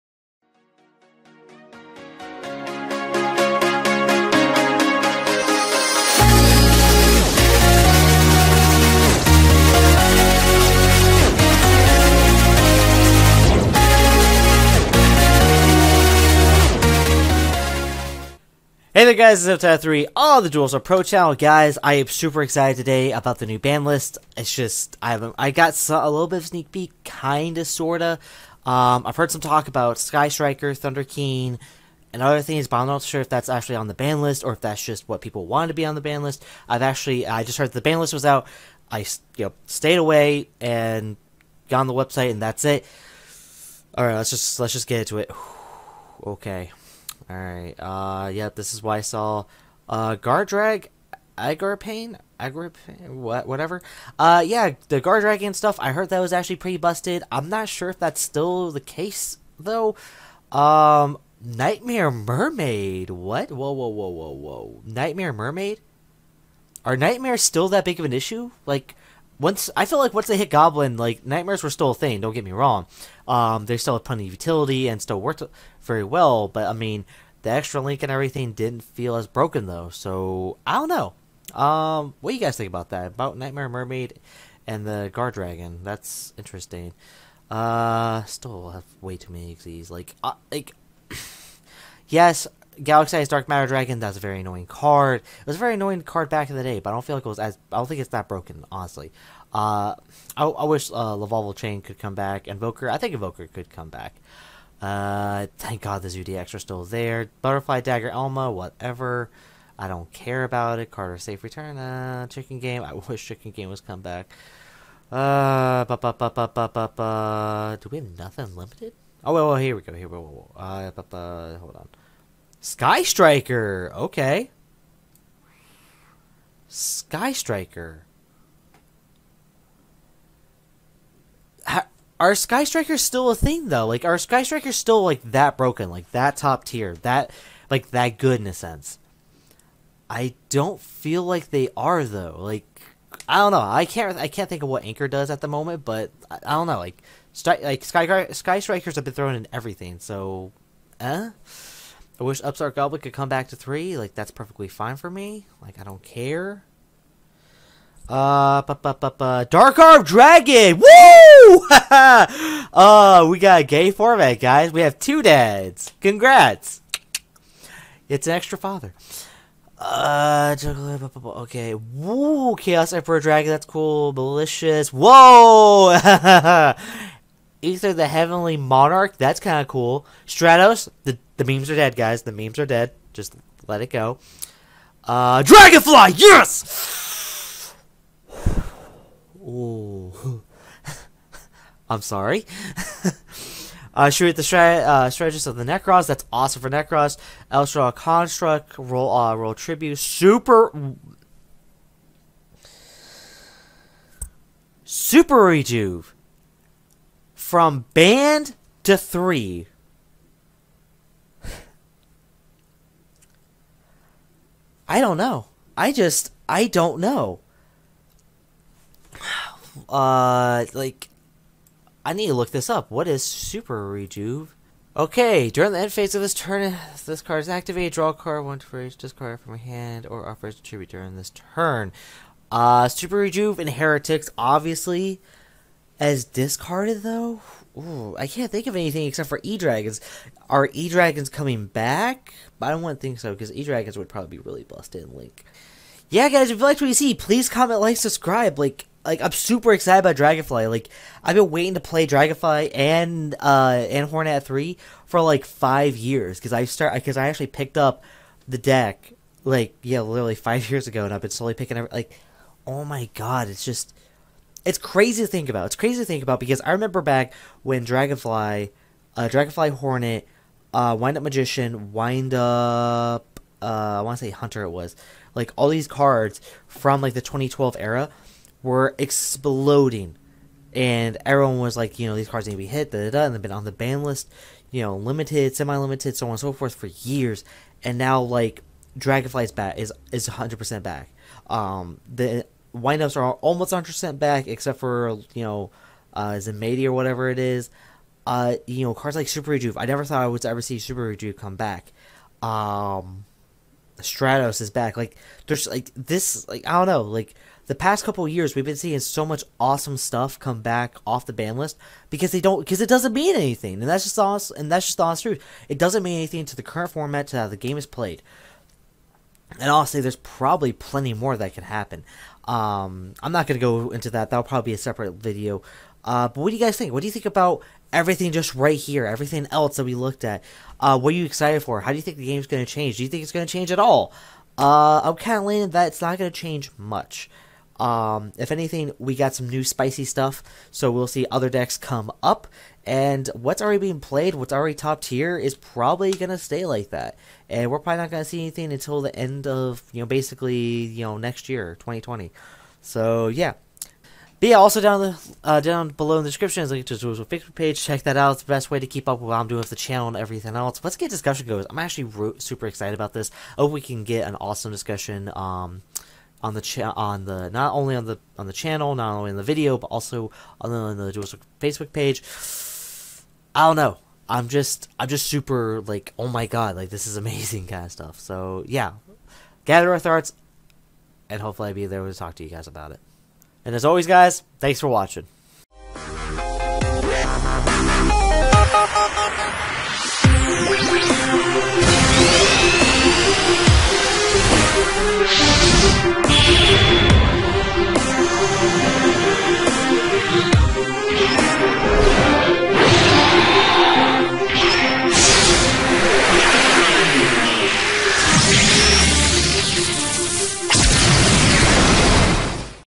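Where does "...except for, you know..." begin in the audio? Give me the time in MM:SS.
04:54.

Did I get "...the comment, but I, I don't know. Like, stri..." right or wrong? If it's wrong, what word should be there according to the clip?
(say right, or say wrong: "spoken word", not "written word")
wrong: "moment", not "comment".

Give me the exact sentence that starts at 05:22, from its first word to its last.
Um, I'm not going to go into that.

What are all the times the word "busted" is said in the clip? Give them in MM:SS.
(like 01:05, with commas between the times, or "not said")
00:56, 04:04.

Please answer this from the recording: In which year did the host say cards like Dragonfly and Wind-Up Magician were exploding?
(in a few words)
2012.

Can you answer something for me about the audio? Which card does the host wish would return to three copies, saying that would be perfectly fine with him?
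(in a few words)
Upstart Goblin.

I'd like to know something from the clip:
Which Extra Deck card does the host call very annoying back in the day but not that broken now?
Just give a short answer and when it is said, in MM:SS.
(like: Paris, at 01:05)
Galaxy-Eyes Dark Matter Dragon, at 01:32.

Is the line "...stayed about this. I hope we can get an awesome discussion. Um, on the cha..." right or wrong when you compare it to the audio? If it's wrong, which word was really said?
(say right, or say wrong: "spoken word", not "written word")
wrong: "excited", not "stayed".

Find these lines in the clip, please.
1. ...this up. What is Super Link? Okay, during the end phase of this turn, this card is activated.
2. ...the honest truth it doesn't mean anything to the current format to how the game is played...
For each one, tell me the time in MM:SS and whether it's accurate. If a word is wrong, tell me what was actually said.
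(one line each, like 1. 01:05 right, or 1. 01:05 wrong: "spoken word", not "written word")
1. 03:42 wrong: "Rejuve", not "Link"
2. 05:14 right.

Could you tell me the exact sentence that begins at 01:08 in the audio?
Like, once I feel like once they hit Goblin, like nightmares were still a thing.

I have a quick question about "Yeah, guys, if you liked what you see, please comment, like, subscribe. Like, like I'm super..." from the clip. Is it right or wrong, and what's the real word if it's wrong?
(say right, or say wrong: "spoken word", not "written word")
right.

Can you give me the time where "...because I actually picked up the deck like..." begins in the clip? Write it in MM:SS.
04:16.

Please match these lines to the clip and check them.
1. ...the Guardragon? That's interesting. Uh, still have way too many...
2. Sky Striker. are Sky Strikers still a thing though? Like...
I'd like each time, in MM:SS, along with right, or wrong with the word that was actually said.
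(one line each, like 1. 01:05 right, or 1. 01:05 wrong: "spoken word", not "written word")
1. 01:24 right
2. 02:06 right.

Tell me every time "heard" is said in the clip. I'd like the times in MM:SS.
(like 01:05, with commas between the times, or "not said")
00:29, 00:37, 00:55.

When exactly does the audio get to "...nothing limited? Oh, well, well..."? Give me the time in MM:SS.
01:58.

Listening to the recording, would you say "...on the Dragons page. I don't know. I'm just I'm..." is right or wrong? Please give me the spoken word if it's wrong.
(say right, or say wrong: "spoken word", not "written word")
wrong: "Facebook", not "Dragons".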